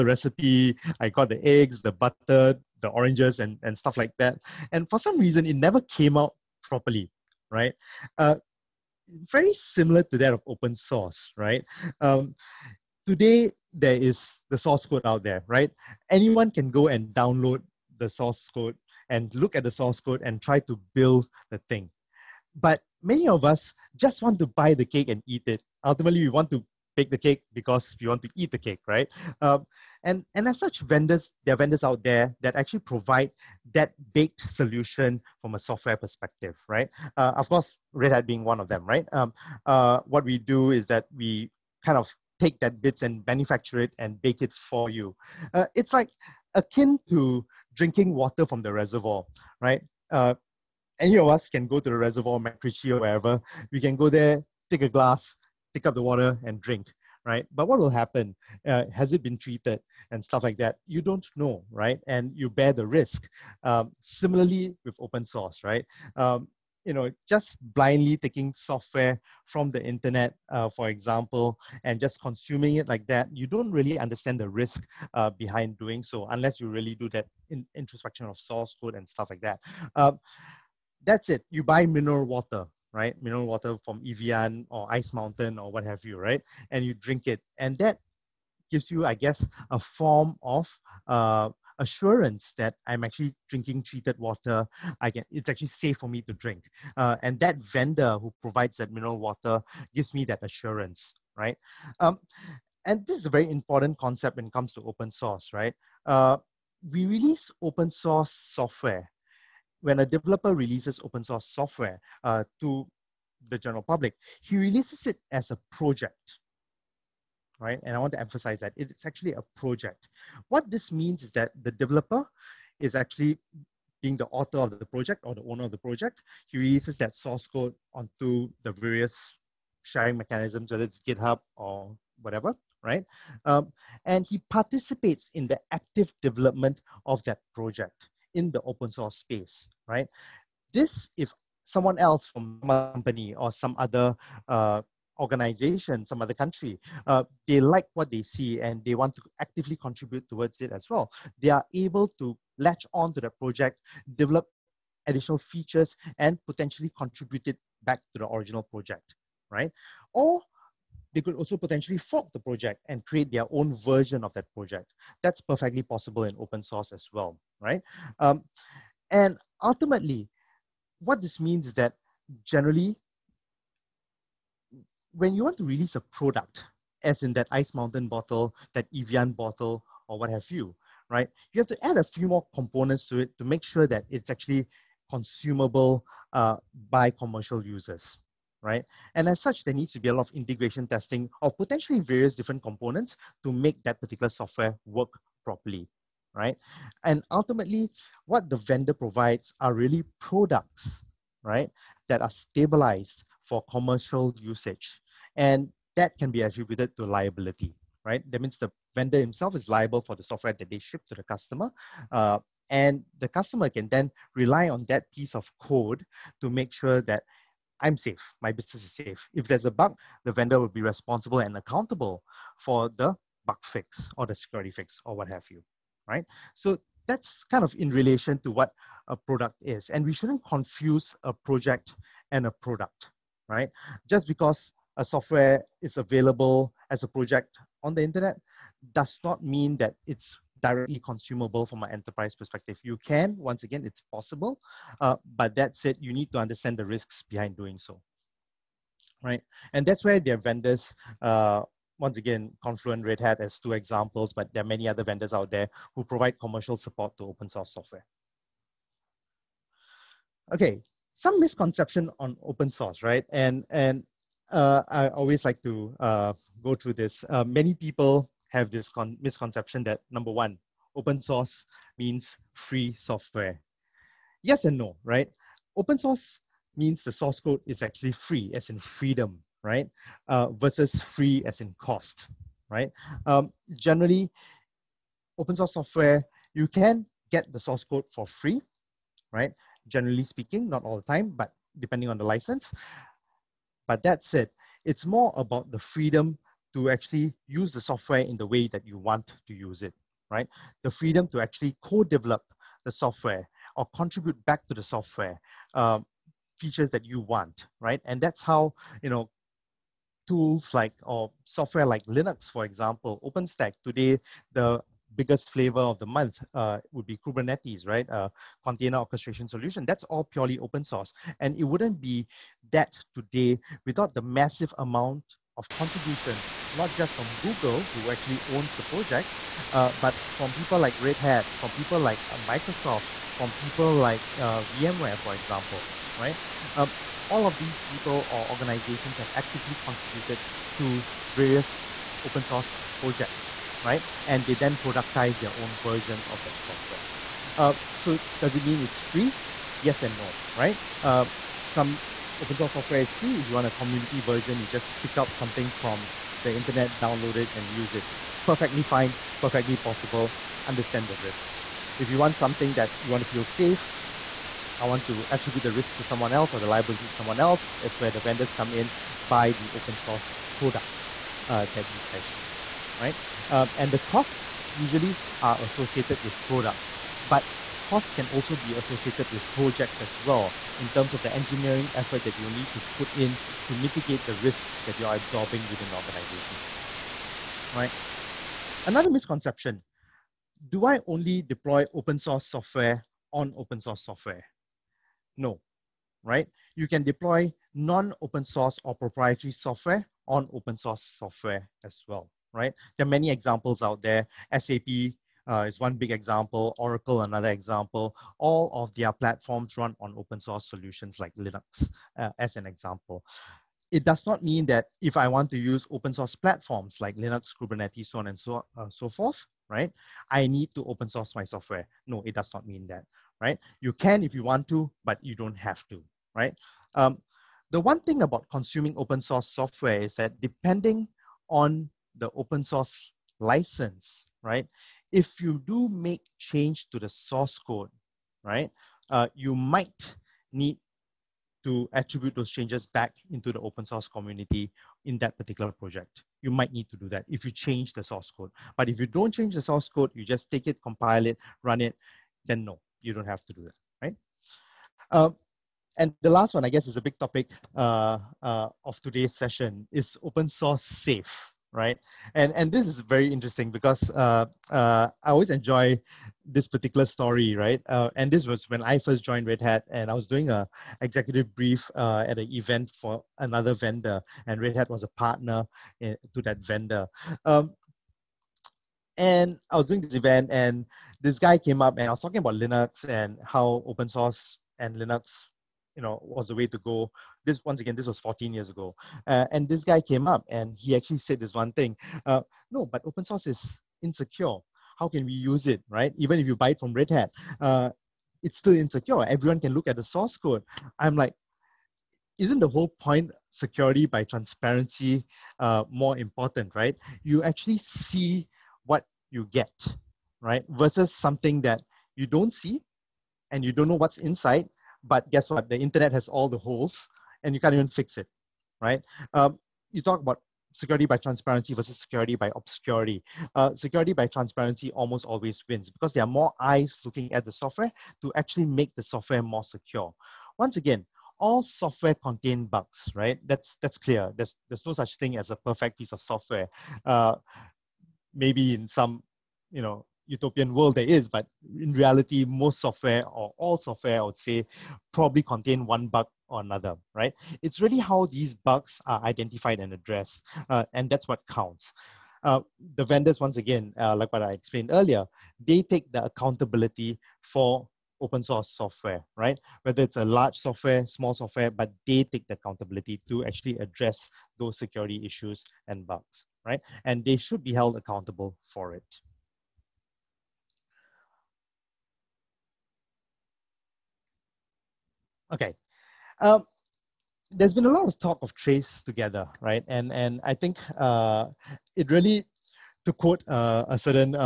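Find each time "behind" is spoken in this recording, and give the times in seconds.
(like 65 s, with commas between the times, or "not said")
75 s, 247 s.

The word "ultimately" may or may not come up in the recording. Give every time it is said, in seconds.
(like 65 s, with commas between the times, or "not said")
25 s, 169 s, 197 s.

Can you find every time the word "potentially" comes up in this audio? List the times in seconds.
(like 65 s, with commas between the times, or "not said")
156 s, 161 s, 191 s.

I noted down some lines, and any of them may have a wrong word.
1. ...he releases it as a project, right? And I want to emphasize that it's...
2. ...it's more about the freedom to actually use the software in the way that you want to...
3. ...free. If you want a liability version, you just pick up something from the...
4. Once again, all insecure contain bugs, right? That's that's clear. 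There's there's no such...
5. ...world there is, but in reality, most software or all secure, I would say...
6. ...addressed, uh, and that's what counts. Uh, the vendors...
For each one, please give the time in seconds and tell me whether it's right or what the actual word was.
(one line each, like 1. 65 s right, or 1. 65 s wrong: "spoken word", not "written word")
1. 114 s right
2. 294 s right
3. 353 s wrong: "community", not "liability"
4. 530 s wrong: "software", not "insecure"
5. 540 s wrong: "software", not "secure"
6. 549 s right.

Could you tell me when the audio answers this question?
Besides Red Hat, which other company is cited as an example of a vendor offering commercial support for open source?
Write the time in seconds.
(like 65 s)
252 s.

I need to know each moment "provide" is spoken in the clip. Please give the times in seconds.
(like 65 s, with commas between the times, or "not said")
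32 s, 98 s, 198 s, 256 s.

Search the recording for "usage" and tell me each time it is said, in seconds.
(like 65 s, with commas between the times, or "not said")
204 s.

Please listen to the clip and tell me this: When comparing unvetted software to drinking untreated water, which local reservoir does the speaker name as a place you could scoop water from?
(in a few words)
MacRitchie.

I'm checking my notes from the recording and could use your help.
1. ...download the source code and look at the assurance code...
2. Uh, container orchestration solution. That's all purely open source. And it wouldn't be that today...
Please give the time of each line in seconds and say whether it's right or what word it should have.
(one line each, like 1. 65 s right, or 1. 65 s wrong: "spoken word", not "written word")
1. 17 s wrong: "source", not "assurance"
2. 318 s right.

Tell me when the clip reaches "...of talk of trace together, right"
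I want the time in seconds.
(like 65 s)
578 s.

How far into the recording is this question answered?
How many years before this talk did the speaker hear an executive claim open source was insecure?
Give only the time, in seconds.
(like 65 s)
488 s.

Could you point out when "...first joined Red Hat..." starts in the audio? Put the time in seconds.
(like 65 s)
468 s.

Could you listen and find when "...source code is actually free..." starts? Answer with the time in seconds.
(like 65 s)
277 s.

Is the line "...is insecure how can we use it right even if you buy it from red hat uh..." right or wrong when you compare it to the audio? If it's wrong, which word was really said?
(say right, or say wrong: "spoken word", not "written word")
right.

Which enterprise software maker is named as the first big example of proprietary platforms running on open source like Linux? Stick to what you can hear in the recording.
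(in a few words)
SAP.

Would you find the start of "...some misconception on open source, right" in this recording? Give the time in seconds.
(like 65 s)
261 s.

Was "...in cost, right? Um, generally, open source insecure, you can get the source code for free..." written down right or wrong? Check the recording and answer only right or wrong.
wrong.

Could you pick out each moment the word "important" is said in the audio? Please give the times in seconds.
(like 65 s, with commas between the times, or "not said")
103 s, 506 s.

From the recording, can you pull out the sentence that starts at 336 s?
Um, all of these people or organizations have actively contributed to various open source projects, right?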